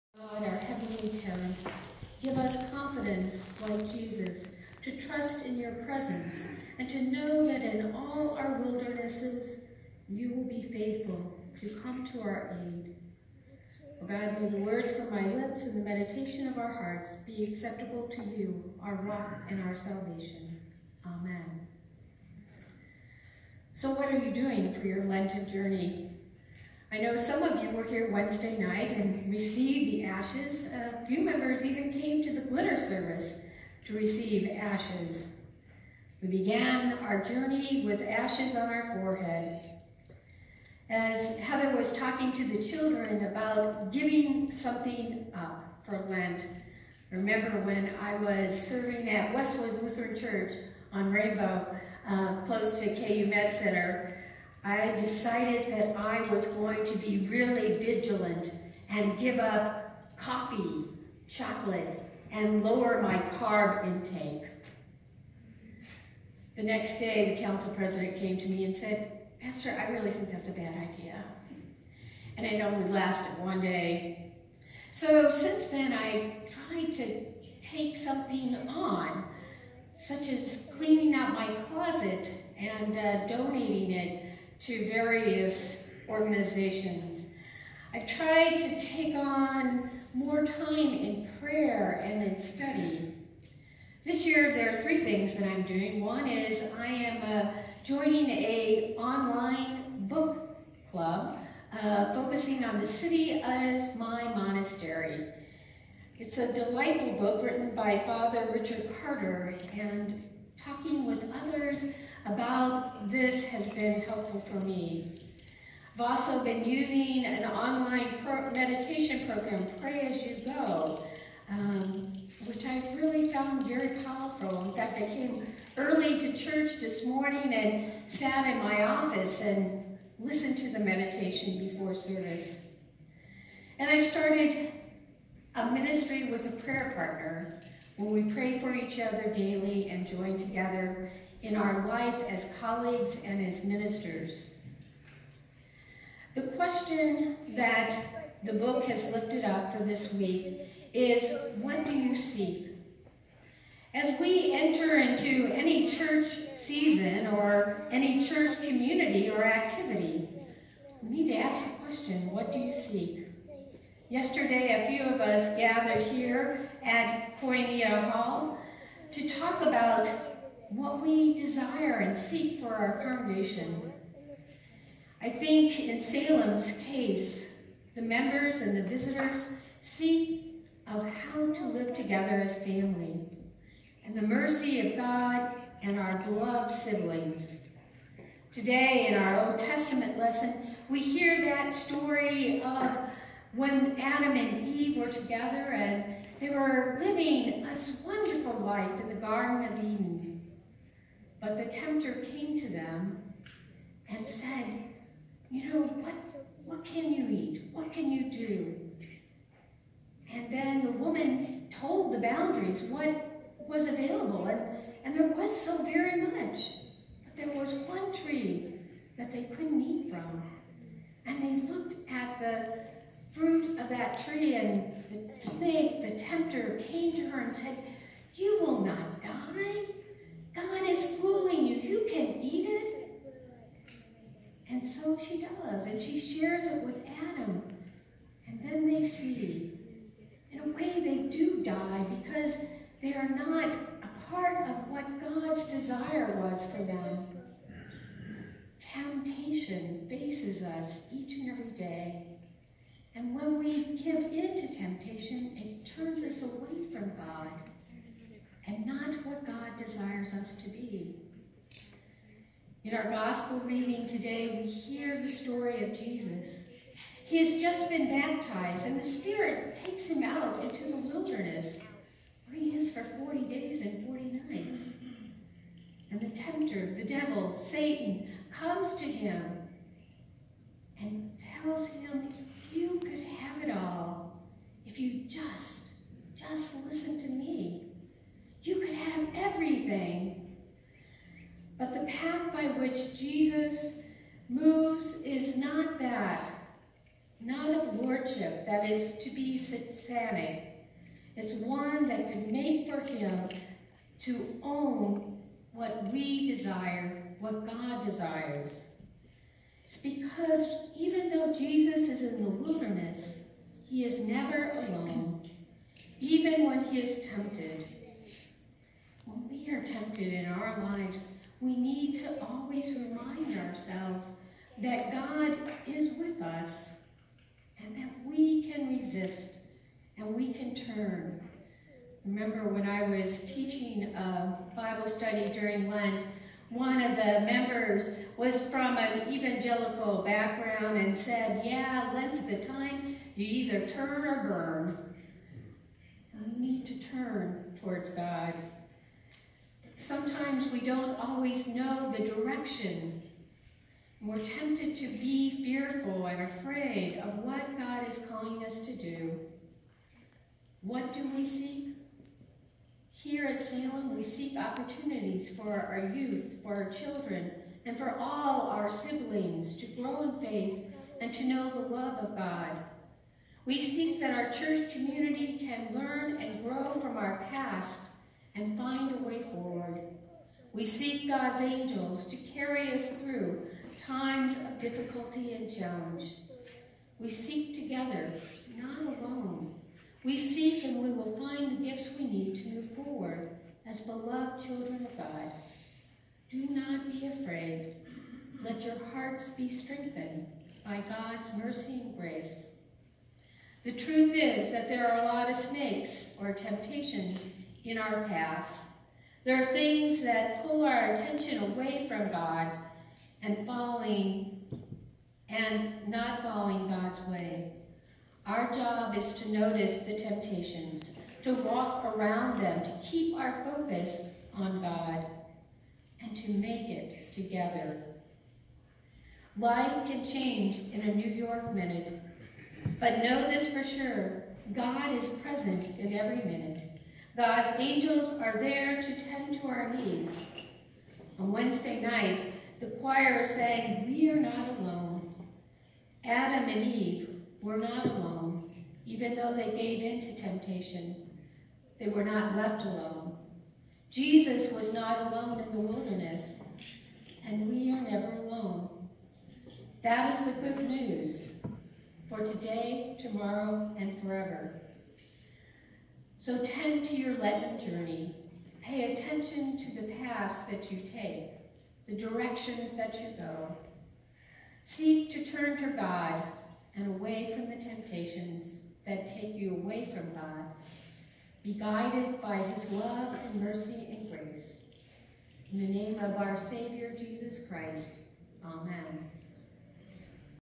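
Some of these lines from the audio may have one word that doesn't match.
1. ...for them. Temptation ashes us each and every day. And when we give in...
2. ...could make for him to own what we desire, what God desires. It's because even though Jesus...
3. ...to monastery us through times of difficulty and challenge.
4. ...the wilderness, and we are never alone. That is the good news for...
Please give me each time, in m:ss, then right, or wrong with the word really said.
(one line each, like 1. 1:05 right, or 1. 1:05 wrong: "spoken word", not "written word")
1. 4:06 wrong: "faces", not "ashes"
2. 5:02 right
3. 6:22 wrong: "carry", not "monastery"
4. 7:35 right.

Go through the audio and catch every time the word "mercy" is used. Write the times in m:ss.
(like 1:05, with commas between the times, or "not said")
3:04, 6:41, 8:03.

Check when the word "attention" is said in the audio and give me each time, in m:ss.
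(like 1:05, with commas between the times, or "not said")
6:51, 7:49.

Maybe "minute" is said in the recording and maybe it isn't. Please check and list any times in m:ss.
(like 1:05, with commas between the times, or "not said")
7:11, 7:16.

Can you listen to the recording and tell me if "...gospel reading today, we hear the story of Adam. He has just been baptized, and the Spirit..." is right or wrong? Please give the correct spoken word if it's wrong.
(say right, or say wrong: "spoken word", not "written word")
wrong: "Jesus", not "Adam".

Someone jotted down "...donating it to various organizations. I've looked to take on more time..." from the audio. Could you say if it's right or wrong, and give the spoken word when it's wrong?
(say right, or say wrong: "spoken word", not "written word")
wrong: "tried", not "looked".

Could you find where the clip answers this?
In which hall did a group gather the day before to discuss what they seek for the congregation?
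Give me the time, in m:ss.
2:47.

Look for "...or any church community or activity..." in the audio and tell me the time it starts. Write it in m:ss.
2:37.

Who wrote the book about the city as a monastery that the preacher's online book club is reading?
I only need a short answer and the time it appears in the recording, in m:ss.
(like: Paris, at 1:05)
Richard Carter, at 1:48.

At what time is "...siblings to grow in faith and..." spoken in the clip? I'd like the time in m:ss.
6:08.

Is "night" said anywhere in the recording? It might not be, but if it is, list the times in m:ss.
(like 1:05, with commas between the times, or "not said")
0:28, 4:34, 7:22.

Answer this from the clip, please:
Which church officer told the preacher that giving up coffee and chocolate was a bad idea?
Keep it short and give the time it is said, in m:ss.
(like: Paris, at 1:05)
council president, at 1:07.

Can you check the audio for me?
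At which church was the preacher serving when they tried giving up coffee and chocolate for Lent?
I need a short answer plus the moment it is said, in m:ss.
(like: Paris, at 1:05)
Westwood Lutheran Church, at 0:49.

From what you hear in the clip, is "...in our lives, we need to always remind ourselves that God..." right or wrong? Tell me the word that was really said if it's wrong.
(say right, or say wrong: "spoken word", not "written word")
right.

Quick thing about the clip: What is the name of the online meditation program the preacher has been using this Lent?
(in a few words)
Pray As You Go.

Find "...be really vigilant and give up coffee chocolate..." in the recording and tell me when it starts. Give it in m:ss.
0:56.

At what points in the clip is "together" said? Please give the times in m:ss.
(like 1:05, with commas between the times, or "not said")
2:20, 3:01, 3:15, 6:27, 7:07.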